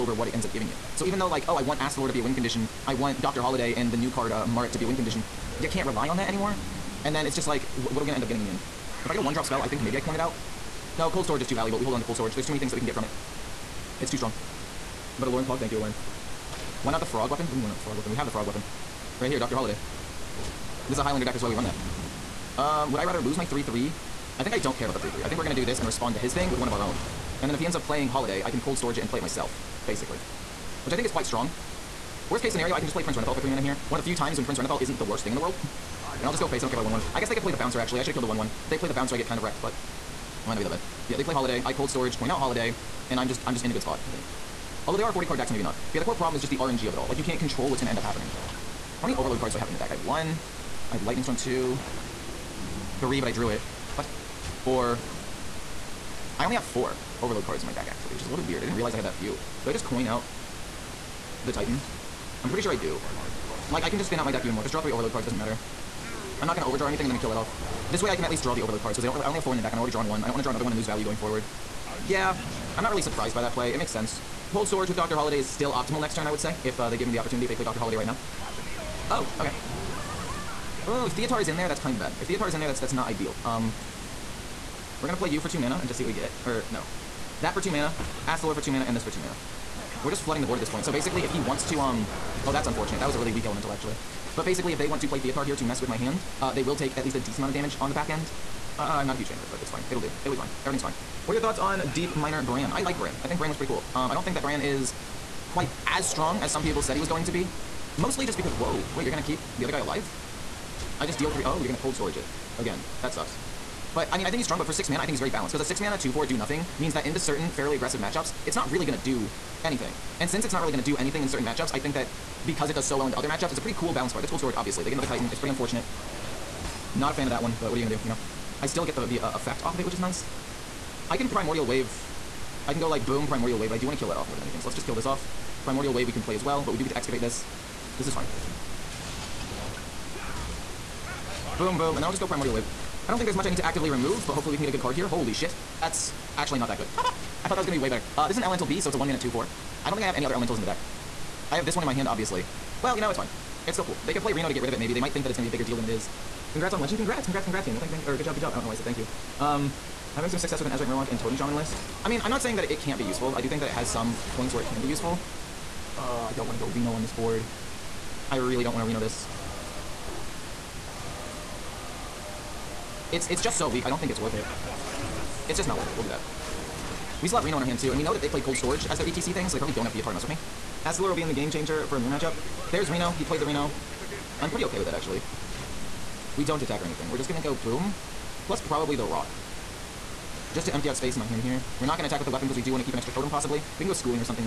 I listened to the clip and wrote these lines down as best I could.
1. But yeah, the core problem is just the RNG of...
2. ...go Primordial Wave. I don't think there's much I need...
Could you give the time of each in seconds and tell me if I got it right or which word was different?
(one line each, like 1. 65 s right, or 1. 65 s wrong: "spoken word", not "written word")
1. 45 s right
2. 142 s right.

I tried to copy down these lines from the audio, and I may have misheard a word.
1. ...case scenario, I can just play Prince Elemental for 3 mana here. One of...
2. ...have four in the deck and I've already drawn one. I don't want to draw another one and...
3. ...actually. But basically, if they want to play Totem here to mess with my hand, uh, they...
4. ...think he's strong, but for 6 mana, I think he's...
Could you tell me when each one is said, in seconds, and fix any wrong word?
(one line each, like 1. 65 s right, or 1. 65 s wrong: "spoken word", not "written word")
1. 32 s wrong: "Renathal", not "Elemental"
2. 69 s right
3. 93 s wrong: "Theotar", not "Totem"
4. 114 s right.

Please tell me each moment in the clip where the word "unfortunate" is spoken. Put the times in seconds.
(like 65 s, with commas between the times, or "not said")
92 s, 125 s.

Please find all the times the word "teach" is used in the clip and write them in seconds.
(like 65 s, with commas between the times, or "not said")
not said.